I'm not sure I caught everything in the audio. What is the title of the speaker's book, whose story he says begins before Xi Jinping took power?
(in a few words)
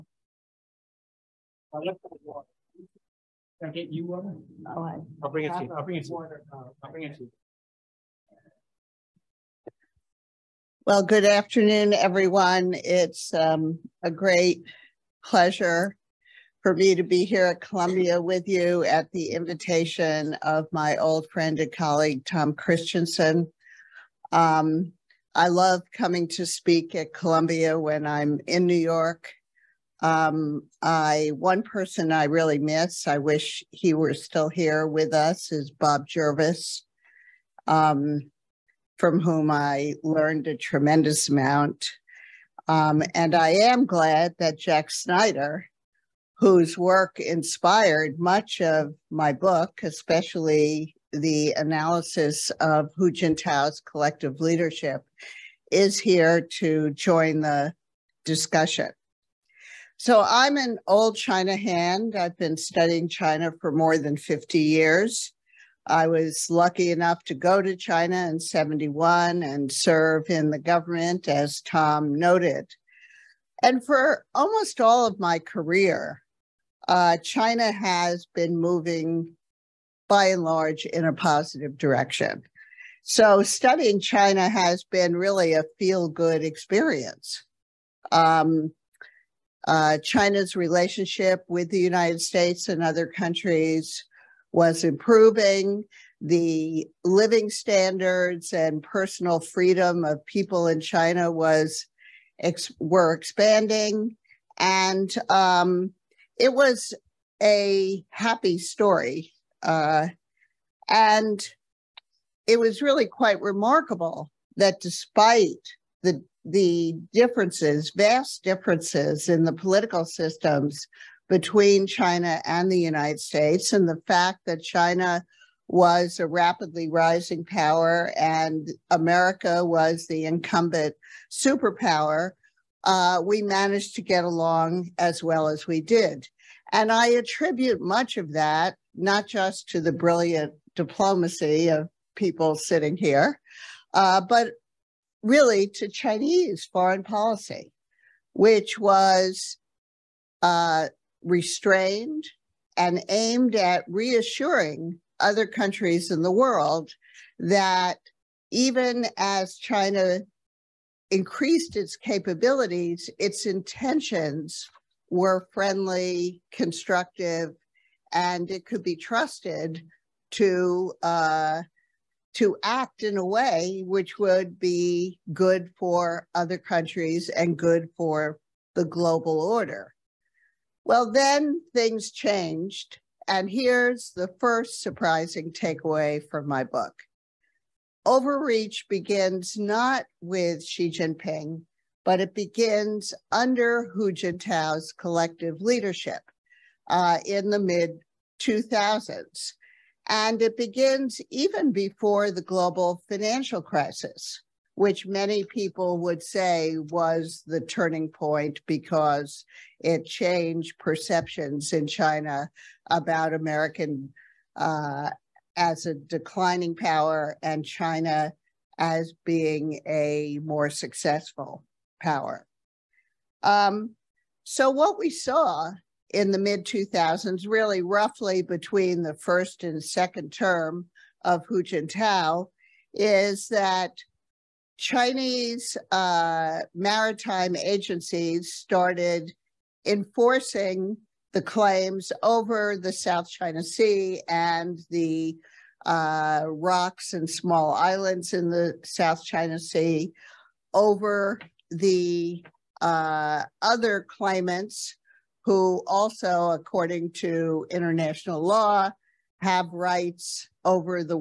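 Overreach.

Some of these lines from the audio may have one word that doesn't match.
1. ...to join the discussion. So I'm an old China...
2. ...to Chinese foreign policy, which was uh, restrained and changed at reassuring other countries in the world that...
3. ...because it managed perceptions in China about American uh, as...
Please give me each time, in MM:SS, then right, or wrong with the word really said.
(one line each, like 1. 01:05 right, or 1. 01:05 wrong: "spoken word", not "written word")
1. 00:56 right
2. 02:25 wrong: "aimed", not "changed"
3. 03:28 wrong: "changed", not "managed".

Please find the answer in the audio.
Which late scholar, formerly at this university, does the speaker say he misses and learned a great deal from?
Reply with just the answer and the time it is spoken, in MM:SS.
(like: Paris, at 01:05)
Bob Jervis, at 00:35.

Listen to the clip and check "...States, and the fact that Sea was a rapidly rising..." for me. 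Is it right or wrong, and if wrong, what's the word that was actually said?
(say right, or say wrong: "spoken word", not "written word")
wrong: "China", not "Sea".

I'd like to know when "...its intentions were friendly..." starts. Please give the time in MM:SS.
02:43.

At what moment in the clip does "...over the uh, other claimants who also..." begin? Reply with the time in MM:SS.
04:10.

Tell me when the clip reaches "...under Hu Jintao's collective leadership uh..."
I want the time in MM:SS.
03:13.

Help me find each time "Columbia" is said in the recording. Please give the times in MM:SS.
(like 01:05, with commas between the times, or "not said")
00:17, 00:27.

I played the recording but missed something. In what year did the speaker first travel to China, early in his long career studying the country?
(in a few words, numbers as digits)
1971.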